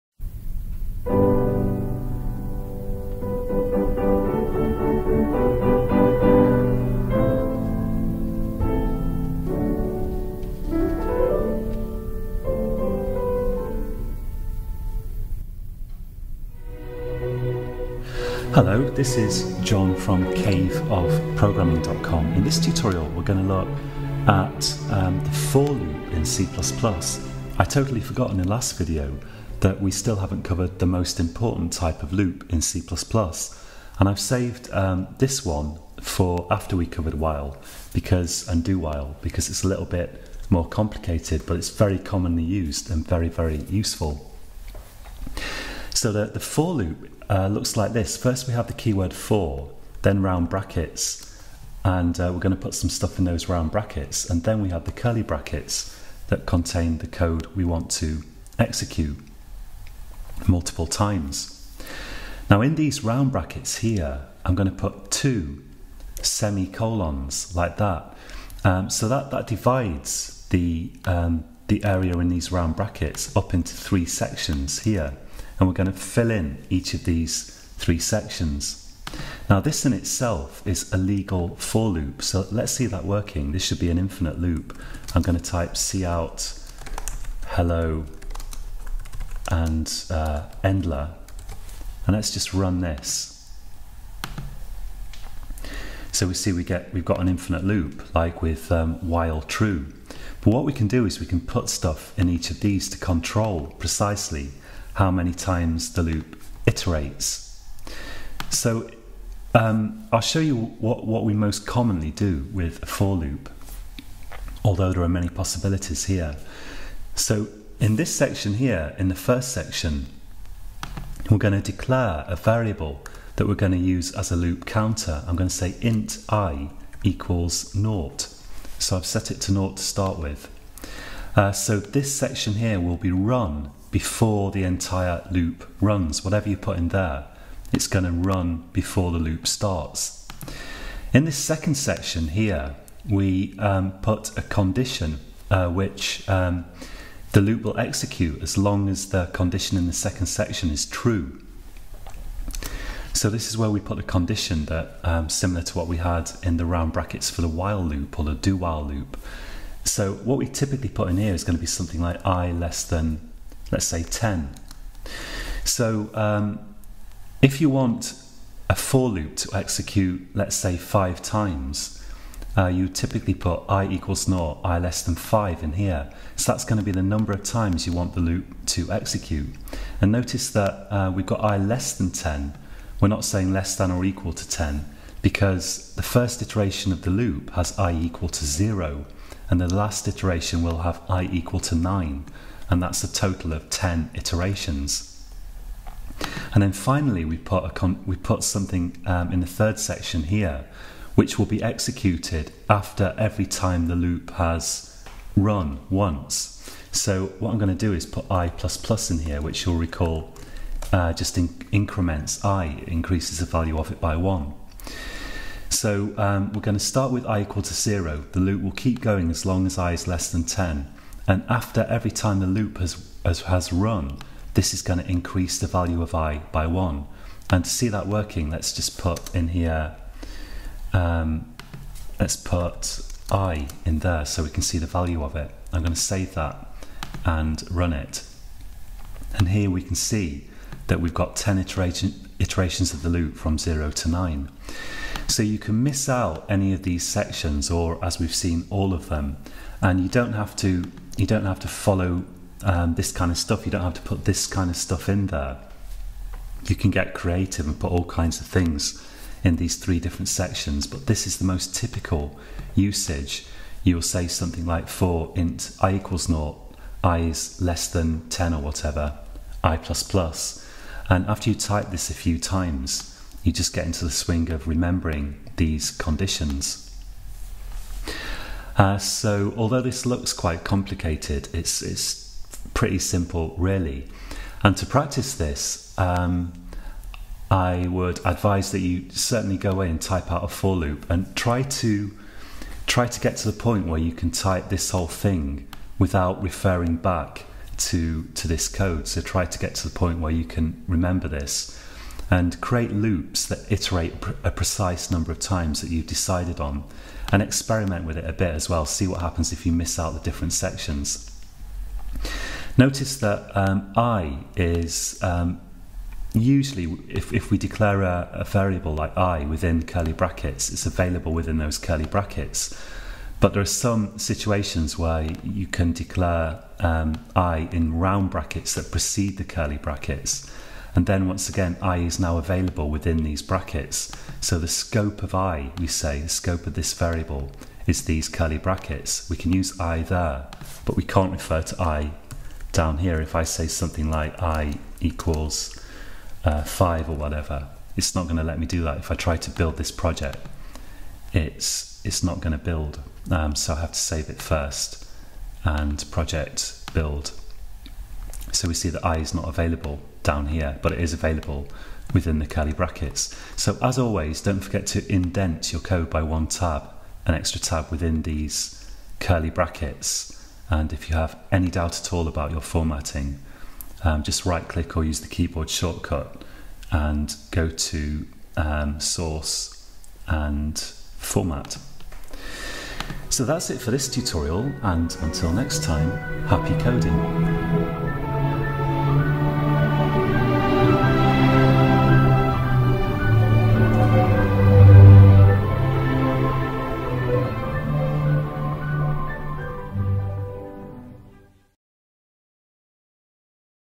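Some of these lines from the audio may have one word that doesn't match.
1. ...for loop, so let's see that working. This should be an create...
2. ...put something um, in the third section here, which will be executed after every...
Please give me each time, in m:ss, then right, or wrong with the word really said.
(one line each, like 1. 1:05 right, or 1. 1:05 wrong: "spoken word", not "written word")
1. 1:21 wrong: "infinite", not "create"
2. 3:18 right.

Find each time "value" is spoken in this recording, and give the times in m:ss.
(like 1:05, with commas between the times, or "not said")
3:33, 3:45, 3:54.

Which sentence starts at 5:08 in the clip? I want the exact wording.
See what happens if you miss out the different sections.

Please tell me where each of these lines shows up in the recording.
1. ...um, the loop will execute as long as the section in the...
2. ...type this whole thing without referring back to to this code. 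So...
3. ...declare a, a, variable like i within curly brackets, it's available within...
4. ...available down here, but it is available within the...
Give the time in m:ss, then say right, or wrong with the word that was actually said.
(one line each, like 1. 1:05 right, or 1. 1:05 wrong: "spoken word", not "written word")
1. 2:26 wrong: "condition", not "section"
2. 4:54 right
3. 5:17 right
4. 5:59 right.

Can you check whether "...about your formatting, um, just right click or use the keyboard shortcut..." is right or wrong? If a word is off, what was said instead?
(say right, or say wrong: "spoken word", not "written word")
right.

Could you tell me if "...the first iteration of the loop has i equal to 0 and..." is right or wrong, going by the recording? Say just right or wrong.
right.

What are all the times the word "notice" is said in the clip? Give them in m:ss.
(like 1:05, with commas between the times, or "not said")
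3:00, 5:12.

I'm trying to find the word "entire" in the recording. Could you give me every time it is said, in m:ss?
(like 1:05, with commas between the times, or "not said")
2:14.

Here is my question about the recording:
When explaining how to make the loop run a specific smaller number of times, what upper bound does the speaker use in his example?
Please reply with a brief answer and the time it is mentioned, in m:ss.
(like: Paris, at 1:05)
5, at 2:54.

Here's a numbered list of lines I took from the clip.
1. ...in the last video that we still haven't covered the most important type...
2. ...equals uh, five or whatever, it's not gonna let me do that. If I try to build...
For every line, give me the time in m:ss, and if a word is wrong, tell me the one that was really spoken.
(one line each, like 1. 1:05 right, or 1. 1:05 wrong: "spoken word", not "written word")
1. 0:28 right
2. 5:44 right.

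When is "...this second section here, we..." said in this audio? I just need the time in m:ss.
2:21.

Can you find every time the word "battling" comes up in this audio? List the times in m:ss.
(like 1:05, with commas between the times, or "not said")
not said.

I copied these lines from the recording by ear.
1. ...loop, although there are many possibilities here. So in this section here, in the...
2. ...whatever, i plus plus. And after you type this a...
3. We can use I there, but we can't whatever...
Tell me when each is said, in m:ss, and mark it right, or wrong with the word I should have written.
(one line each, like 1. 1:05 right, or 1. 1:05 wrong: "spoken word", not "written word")
1. 1:53 right
2. 4:28 right
3. 5:39 wrong: "refer", not "whatever".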